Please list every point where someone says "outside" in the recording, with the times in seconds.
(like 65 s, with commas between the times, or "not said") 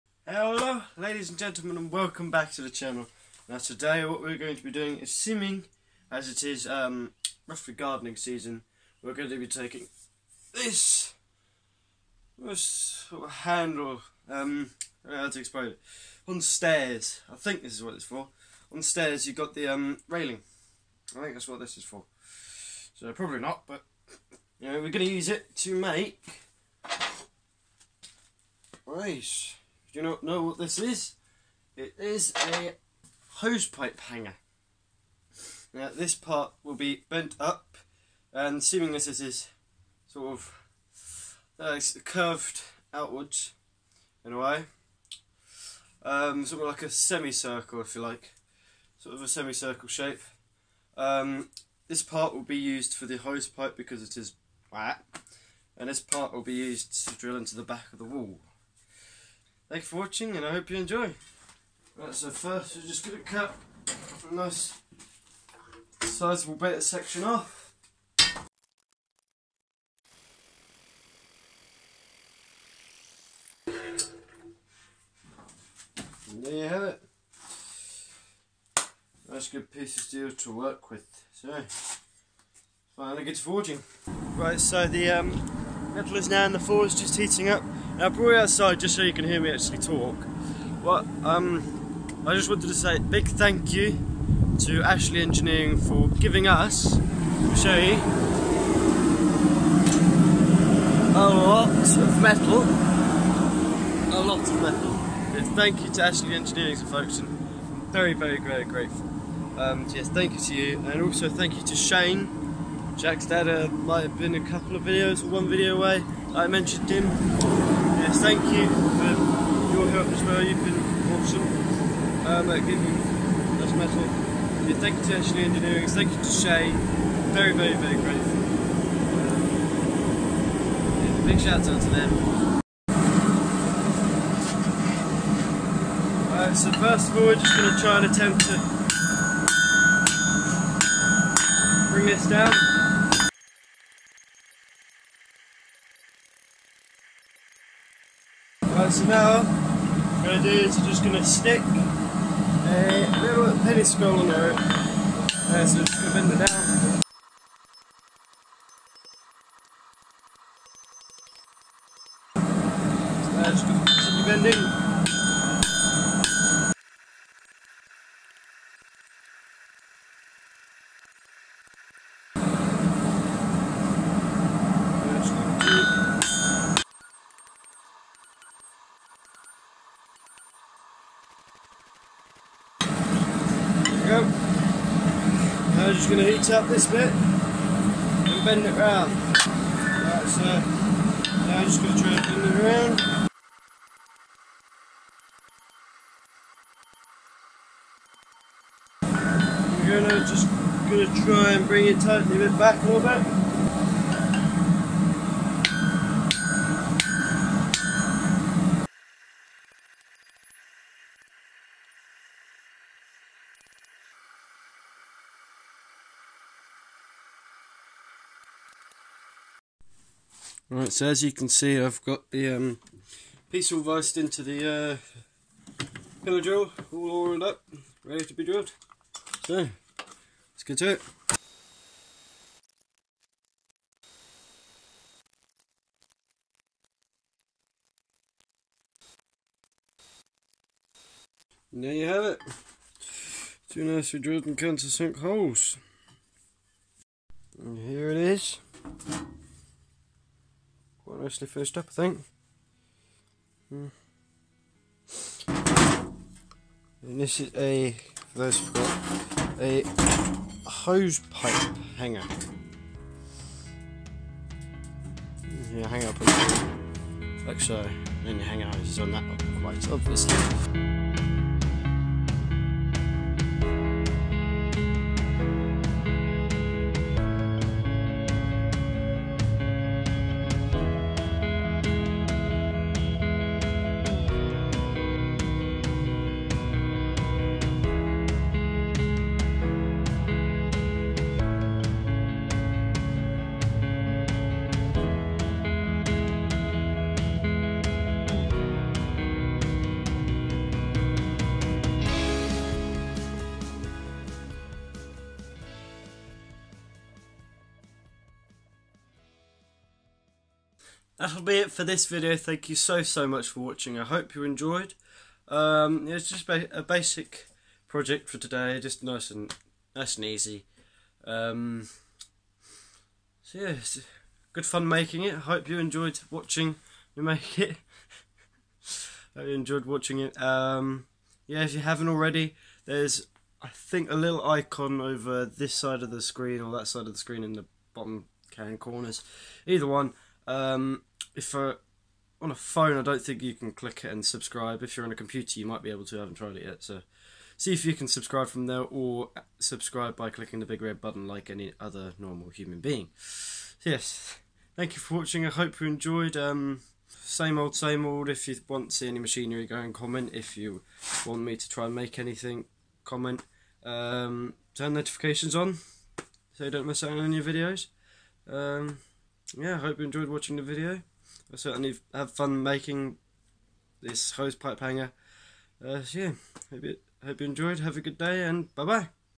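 88 s.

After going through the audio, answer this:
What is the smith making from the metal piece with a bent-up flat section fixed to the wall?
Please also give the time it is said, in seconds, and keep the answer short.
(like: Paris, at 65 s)
Hosepipe hanger, at 33 s.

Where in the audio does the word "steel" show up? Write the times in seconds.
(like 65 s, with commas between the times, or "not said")
80 s.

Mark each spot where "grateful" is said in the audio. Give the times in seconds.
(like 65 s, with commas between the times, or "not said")
108 s, 127 s.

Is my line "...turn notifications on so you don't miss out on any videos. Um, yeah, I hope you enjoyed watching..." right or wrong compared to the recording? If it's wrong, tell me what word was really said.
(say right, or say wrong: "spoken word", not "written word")
right.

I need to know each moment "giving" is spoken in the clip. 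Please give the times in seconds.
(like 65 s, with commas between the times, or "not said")
96 s, 122 s.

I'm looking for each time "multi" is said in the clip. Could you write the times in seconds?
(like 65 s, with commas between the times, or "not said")
not said.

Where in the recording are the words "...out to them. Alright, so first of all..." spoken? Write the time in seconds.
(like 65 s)
131 s.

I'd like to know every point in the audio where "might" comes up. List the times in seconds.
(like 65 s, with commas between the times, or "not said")
113 s, 345 s.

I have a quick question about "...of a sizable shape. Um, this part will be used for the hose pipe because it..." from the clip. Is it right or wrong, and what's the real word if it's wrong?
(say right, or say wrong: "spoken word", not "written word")
wrong: "semicircle", not "sizable".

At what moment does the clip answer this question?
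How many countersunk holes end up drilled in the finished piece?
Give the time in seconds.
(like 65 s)
243 s.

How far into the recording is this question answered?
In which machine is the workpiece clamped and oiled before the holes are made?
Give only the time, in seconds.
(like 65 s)
226 s.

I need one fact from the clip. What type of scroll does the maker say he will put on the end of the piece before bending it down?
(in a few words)
Penny scroll.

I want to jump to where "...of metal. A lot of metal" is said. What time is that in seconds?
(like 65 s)
101 s.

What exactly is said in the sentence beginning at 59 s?
Thanks for watching and I hope you enjoy.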